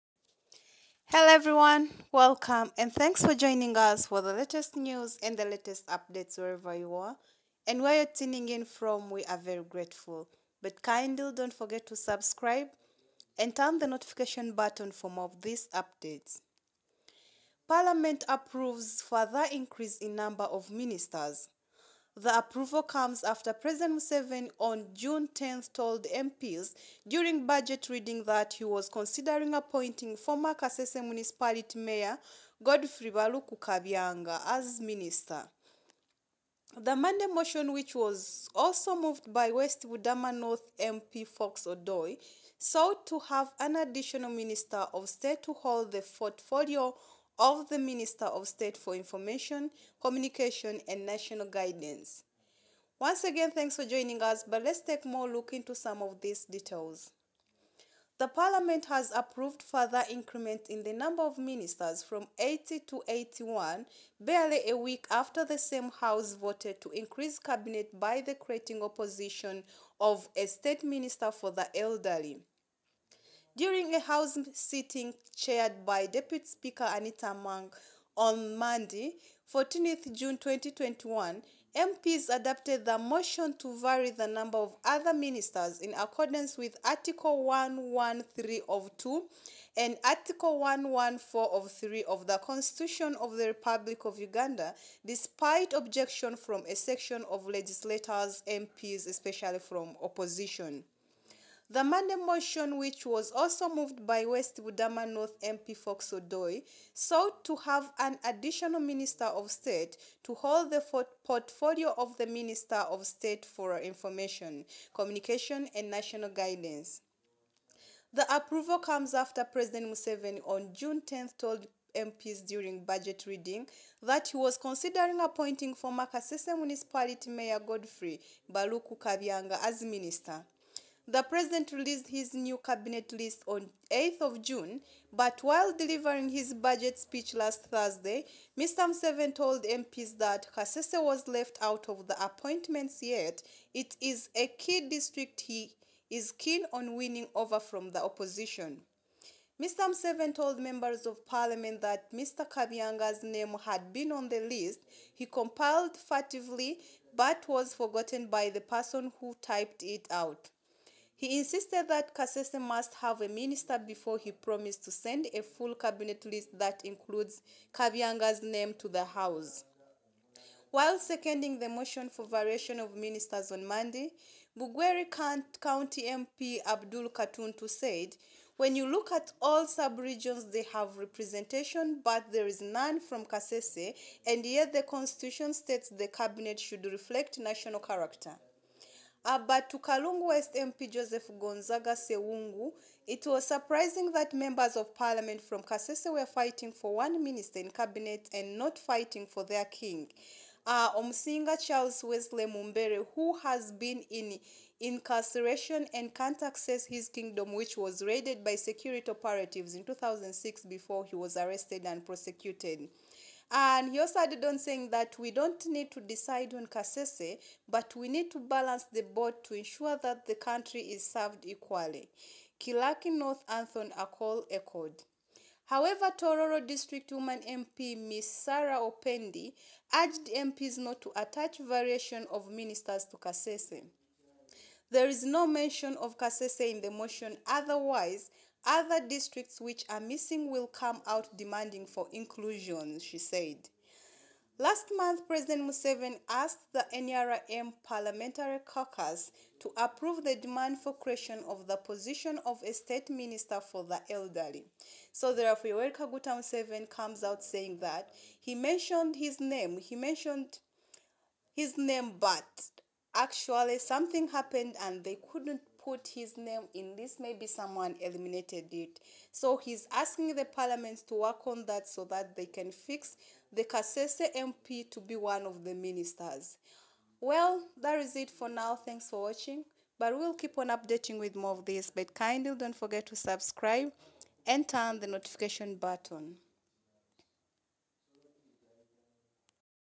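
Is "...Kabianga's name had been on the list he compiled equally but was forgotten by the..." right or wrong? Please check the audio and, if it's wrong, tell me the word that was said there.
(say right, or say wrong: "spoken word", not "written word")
wrong: "furtively", not "equally".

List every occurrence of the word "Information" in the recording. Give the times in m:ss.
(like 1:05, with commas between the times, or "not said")
0:48, 1:53.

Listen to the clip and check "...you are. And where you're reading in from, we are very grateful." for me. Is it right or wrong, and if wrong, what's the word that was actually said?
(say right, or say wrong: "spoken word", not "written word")
wrong: "tuning", not "reading".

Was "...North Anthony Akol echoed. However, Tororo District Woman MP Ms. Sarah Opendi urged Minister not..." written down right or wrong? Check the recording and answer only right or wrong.
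wrong.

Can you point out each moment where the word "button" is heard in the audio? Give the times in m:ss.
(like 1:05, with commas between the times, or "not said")
0:14, 4:45.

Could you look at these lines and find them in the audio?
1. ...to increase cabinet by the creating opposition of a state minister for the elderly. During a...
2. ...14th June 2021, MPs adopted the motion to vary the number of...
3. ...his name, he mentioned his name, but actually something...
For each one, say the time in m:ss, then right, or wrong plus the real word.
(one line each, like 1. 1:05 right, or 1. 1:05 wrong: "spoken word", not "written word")
1. 1:06 right
2. 1:19 right
3. 4:19 right.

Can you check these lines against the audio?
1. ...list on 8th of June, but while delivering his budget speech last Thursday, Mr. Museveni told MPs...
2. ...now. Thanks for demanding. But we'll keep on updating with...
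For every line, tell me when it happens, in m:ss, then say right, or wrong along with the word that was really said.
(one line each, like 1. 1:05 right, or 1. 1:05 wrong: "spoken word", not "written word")
1. 2:13 right
2. 4:38 wrong: "watching", not "demanding".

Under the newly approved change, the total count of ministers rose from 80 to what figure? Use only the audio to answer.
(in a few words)
81.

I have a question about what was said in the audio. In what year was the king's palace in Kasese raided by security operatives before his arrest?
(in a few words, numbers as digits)
2006.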